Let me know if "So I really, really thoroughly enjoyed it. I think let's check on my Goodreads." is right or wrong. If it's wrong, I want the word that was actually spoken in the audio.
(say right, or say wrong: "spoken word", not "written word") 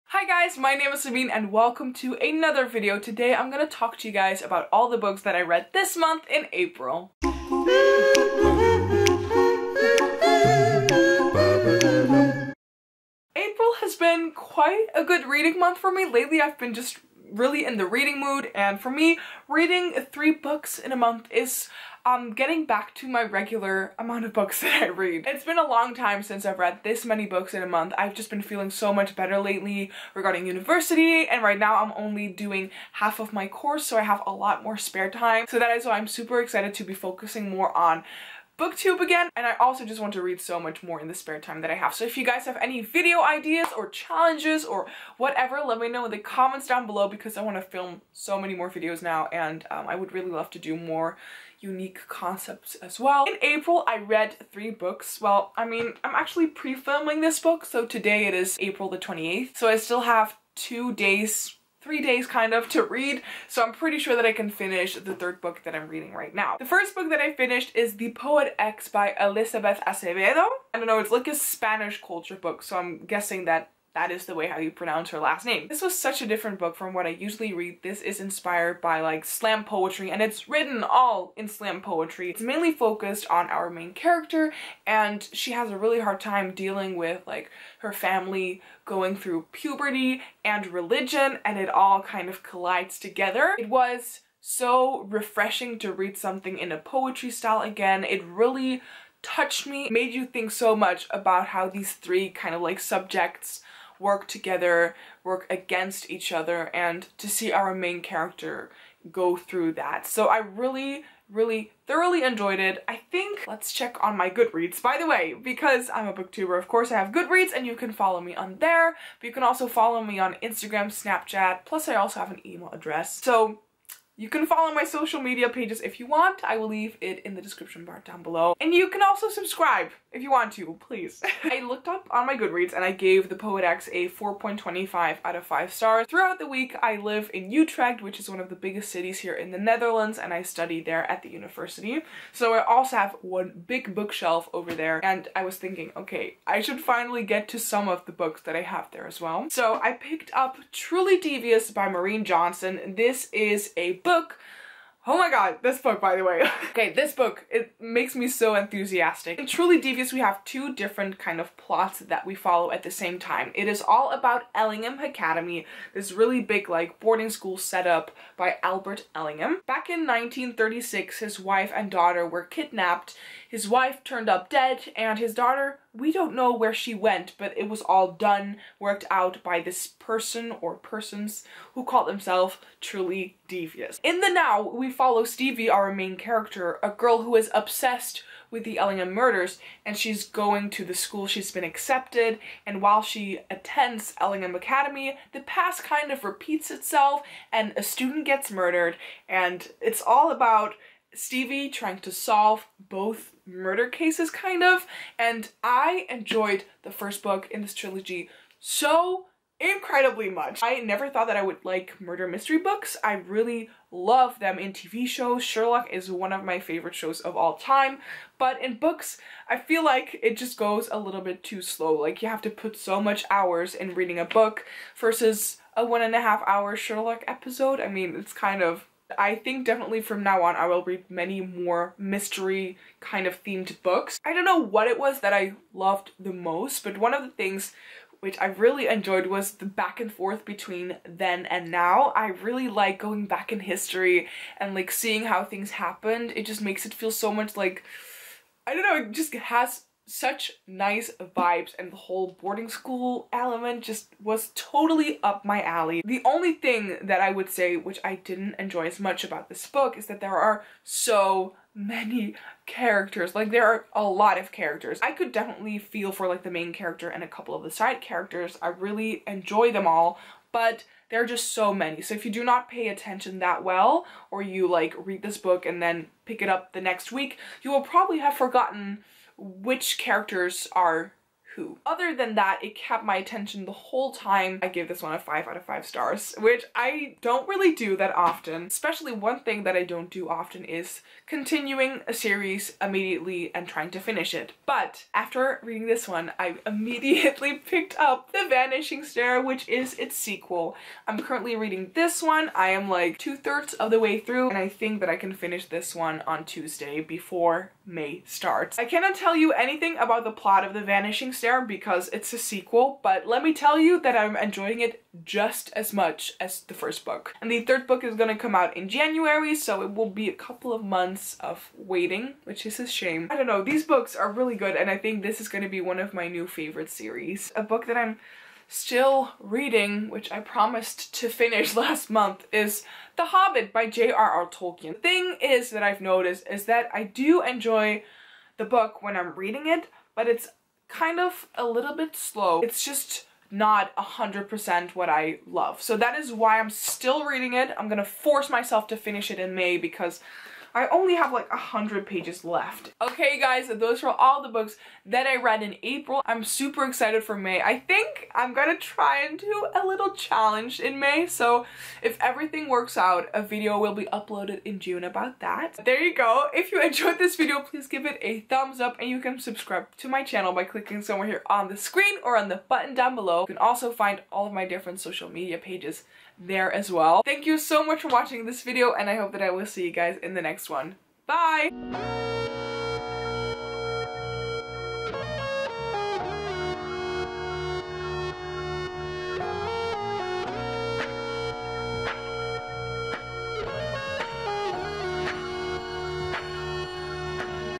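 right.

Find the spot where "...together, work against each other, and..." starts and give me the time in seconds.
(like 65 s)
104 s.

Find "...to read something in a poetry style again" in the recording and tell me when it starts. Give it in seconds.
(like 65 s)
95 s.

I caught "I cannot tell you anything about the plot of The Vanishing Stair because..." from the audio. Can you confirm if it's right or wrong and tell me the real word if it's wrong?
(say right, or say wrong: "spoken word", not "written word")
right.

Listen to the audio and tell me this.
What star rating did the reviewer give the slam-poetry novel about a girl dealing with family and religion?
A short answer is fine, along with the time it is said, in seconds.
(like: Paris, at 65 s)
4.25 out of 5, at 134 s.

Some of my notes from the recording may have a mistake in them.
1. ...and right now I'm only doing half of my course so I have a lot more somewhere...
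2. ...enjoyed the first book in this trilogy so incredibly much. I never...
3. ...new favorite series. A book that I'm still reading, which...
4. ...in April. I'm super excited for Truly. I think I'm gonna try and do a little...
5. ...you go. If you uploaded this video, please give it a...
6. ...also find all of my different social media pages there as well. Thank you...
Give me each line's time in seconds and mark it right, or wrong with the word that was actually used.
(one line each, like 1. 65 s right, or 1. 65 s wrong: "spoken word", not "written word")
1. 31 s wrong: "spare", not "somewhere"
2. 206 s right
3. 326 s right
4. 355 s wrong: "May", not "Truly"
5. 366 s wrong: "enjoyed", not "uploaded"
6. 373 s right.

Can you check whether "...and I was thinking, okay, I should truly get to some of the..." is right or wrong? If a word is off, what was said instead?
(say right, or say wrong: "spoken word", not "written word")
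wrong: "finally", not "truly".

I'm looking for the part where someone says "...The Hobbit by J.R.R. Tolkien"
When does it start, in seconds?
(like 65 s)
333 s.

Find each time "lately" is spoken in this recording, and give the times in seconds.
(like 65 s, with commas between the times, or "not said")
16 s, 29 s.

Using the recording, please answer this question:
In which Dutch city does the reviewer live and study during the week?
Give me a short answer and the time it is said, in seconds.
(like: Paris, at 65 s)
Utrecht, at 137 s.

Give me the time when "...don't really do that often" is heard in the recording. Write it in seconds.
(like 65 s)
287 s.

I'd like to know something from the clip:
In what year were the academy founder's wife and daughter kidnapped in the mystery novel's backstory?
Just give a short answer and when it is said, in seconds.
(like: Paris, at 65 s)
1936, at 170 s.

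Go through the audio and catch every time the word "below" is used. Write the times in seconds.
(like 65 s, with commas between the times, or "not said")
46 s, 128 s, 373 s.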